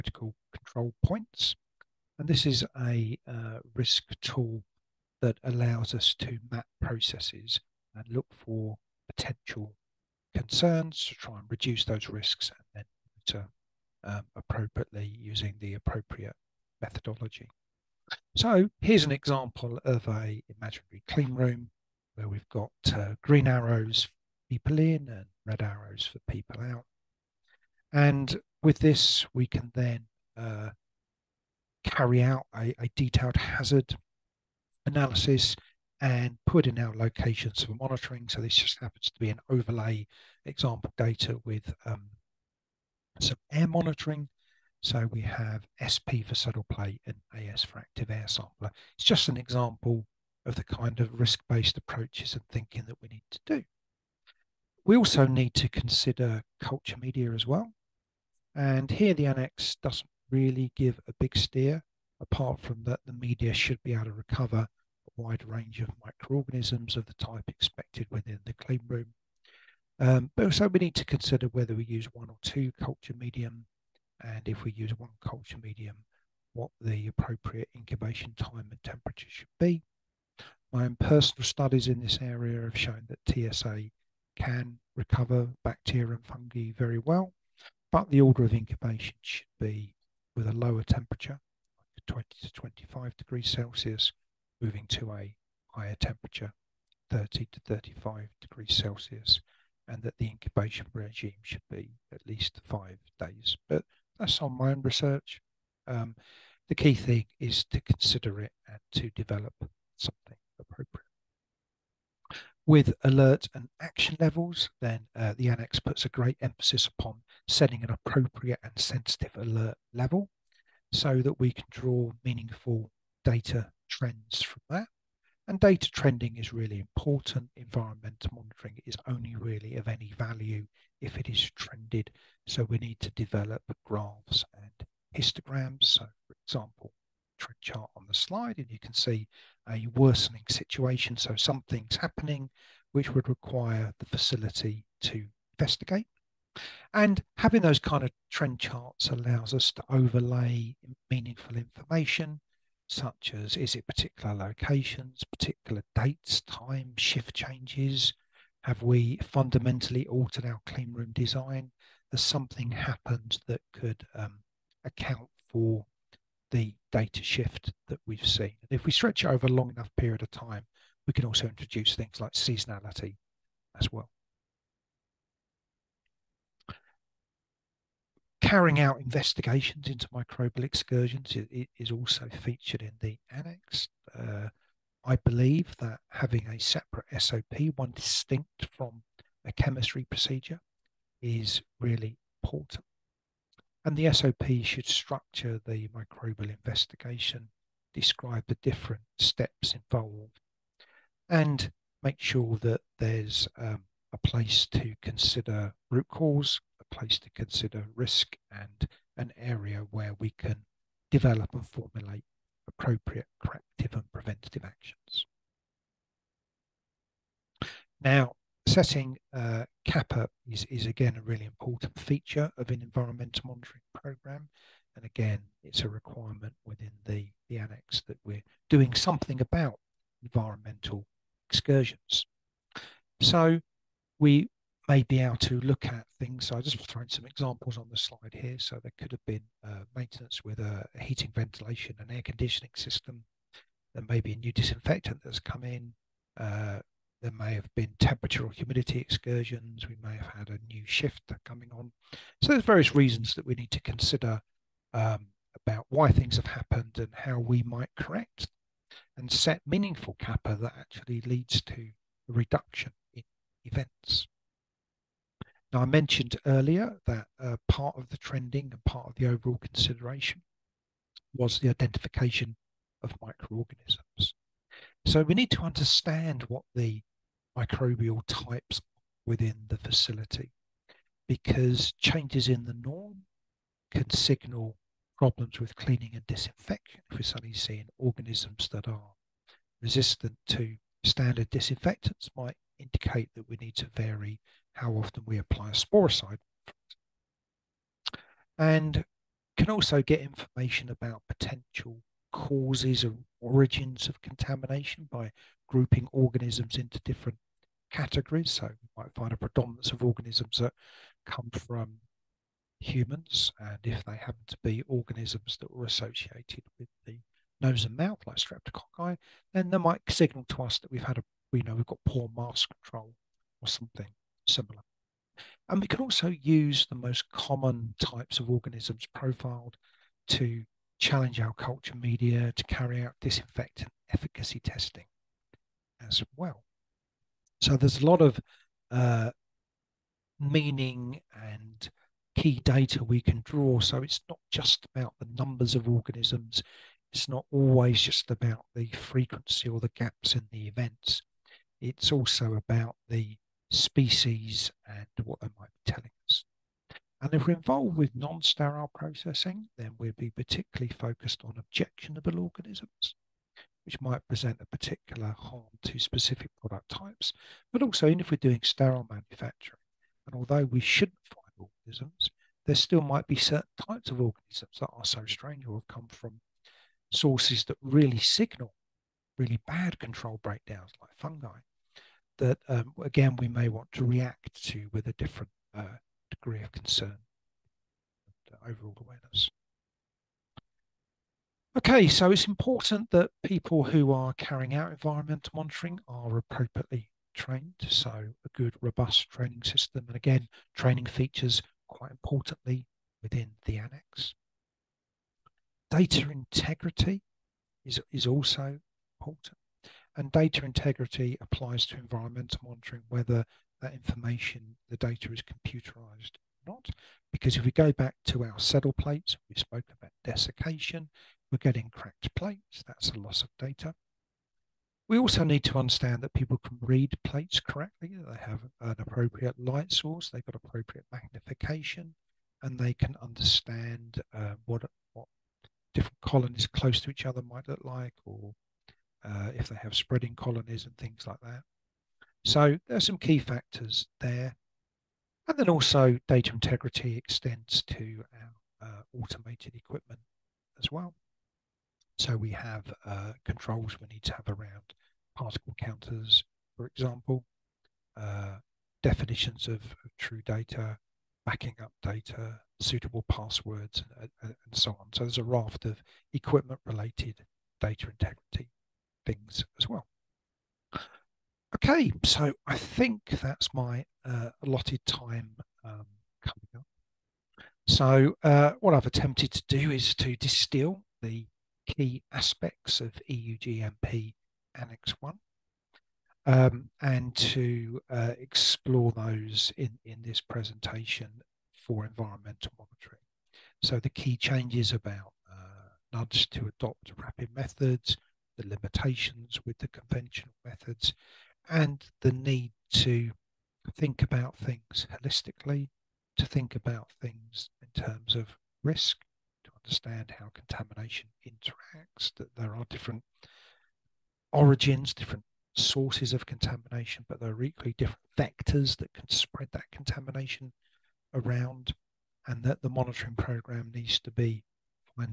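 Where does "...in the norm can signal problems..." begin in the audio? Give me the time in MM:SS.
04:42.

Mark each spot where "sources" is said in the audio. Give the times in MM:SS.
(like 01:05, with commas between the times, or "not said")
06:17, 07:09, 08:35.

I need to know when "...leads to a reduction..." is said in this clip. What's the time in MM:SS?
04:21.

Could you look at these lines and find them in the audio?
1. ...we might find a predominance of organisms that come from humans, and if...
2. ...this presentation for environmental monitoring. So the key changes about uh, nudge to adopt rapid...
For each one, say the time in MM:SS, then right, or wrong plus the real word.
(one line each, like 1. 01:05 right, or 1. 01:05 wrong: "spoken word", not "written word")
1. 05:08 right
2. 08:10 right.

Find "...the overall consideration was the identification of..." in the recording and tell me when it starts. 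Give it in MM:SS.
04:29.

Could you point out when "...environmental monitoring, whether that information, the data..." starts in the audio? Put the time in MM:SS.
06:51.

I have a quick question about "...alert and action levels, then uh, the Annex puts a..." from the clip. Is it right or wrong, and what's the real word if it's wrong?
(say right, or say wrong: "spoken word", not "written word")
right.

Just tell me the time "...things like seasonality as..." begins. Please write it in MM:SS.
02:51.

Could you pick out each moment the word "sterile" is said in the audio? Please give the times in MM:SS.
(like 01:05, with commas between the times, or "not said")
05:58, 06:08.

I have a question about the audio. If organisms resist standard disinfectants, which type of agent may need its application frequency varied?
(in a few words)
sporicide.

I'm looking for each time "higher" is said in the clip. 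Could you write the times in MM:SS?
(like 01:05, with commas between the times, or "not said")
01:35.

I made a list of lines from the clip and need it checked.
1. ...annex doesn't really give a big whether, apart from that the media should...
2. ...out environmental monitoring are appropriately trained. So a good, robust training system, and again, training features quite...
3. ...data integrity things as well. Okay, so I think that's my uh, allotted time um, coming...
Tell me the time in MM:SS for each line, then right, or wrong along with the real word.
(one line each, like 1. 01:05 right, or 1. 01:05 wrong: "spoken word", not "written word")
1. 00:59 wrong: "steer", not "whether"
2. 06:34 right
3. 07:47 right.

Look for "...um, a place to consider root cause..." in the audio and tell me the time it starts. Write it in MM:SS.
03:23.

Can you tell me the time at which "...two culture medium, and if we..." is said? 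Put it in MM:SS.
01:12.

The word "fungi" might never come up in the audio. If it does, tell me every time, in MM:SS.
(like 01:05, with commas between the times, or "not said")
01:26, 06:21.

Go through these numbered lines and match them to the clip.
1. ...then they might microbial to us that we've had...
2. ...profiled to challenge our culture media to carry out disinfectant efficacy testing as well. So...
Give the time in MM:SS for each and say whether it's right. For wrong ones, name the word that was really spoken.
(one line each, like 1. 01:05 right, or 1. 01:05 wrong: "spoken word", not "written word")
1. 05:19 wrong: "signal", not "microbial"
2. 05:29 right.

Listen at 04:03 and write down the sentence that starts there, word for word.
There may be a new disinfectant that's come in.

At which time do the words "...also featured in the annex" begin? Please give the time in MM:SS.
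03:01.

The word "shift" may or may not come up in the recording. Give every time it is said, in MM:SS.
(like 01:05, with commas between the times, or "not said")
02:36, 02:47, 04:10.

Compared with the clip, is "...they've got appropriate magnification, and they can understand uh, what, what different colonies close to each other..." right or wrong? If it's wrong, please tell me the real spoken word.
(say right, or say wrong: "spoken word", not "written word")
right.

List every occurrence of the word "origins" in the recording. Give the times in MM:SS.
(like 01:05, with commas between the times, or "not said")
05:03, 08:34.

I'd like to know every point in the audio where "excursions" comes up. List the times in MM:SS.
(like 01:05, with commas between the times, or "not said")
03:00, 03:51, 04:08.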